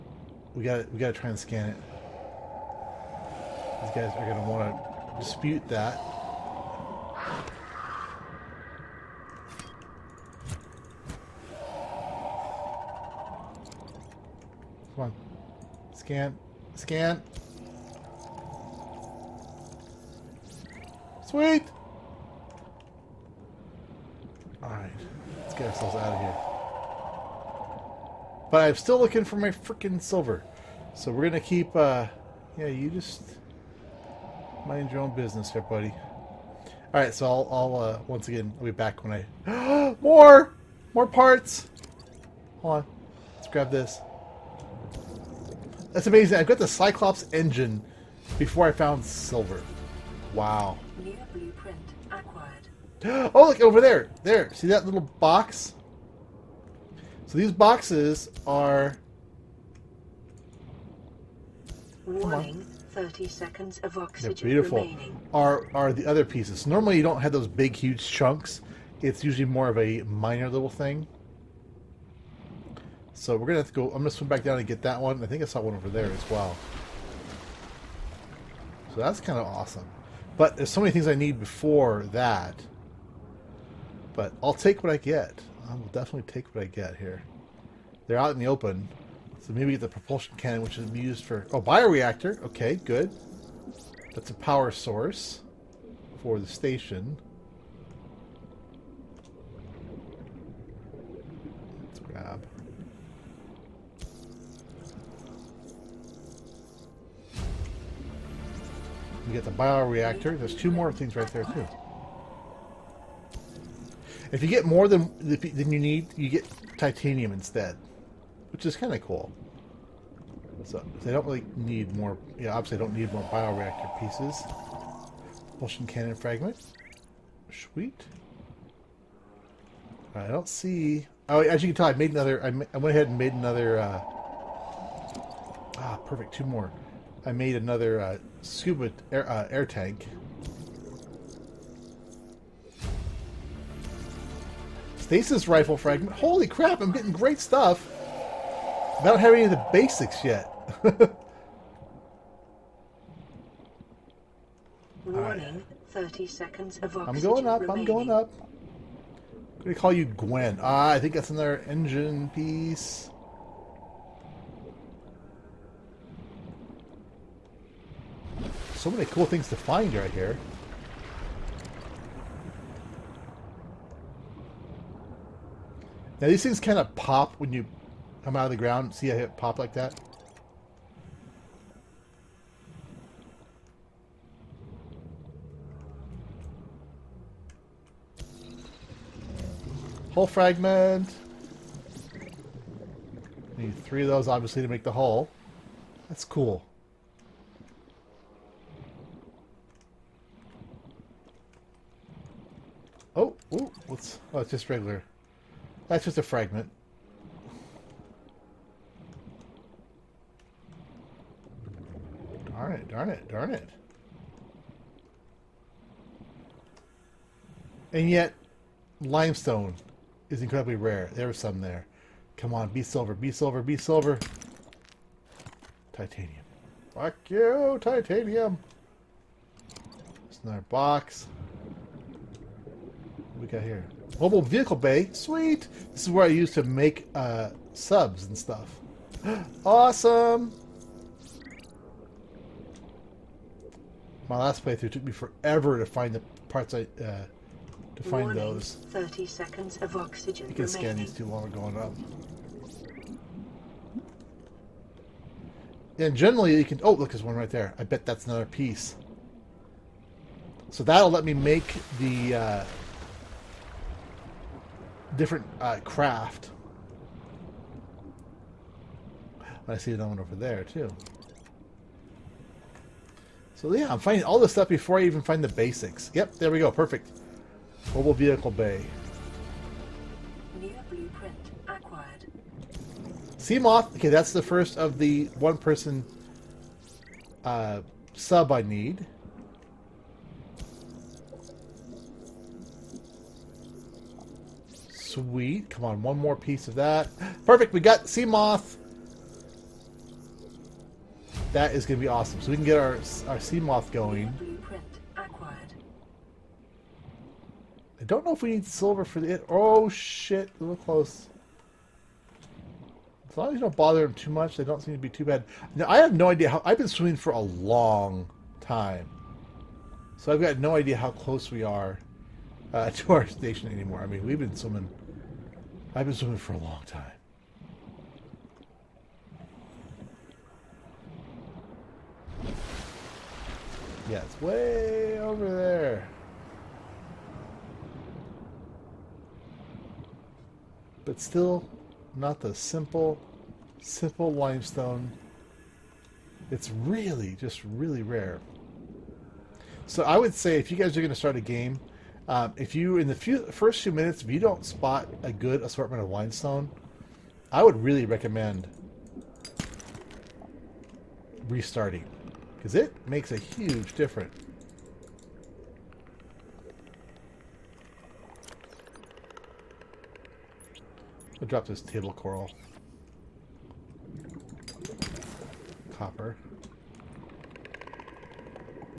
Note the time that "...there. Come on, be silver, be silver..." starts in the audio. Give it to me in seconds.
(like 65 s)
221 s.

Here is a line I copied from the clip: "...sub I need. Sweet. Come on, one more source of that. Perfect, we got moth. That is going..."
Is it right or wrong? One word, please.
wrong.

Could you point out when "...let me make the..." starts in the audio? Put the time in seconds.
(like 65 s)
261 s.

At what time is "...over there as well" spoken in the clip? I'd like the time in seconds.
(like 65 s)
75 s.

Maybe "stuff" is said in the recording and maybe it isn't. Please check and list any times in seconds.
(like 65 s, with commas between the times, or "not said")
147 s, 238 s, 274 s.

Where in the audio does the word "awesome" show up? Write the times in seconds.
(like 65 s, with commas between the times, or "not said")
79 s, 239 s, 302 s.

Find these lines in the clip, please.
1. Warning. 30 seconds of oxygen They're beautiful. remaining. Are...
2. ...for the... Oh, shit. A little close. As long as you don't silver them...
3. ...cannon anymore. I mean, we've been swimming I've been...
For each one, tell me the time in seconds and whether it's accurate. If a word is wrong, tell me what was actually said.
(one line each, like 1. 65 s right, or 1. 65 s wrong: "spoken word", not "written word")
1. 62 s right
2. 309 s wrong: "bother", not "silver"
3. 323 s wrong: "station", not "cannon".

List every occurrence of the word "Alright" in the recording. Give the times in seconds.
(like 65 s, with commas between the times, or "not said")
24 s, 36 s.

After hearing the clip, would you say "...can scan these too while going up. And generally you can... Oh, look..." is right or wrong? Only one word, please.
right.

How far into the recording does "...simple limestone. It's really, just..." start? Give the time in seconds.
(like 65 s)
343 s.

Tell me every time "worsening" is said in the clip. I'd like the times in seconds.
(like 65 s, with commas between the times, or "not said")
not said.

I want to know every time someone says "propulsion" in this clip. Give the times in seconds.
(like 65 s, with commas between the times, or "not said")
89 s, 125 s.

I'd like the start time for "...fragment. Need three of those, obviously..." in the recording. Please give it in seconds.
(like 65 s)
190 s.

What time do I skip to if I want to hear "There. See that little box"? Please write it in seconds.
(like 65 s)
54 s.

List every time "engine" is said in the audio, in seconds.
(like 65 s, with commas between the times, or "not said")
47 s, 161 s.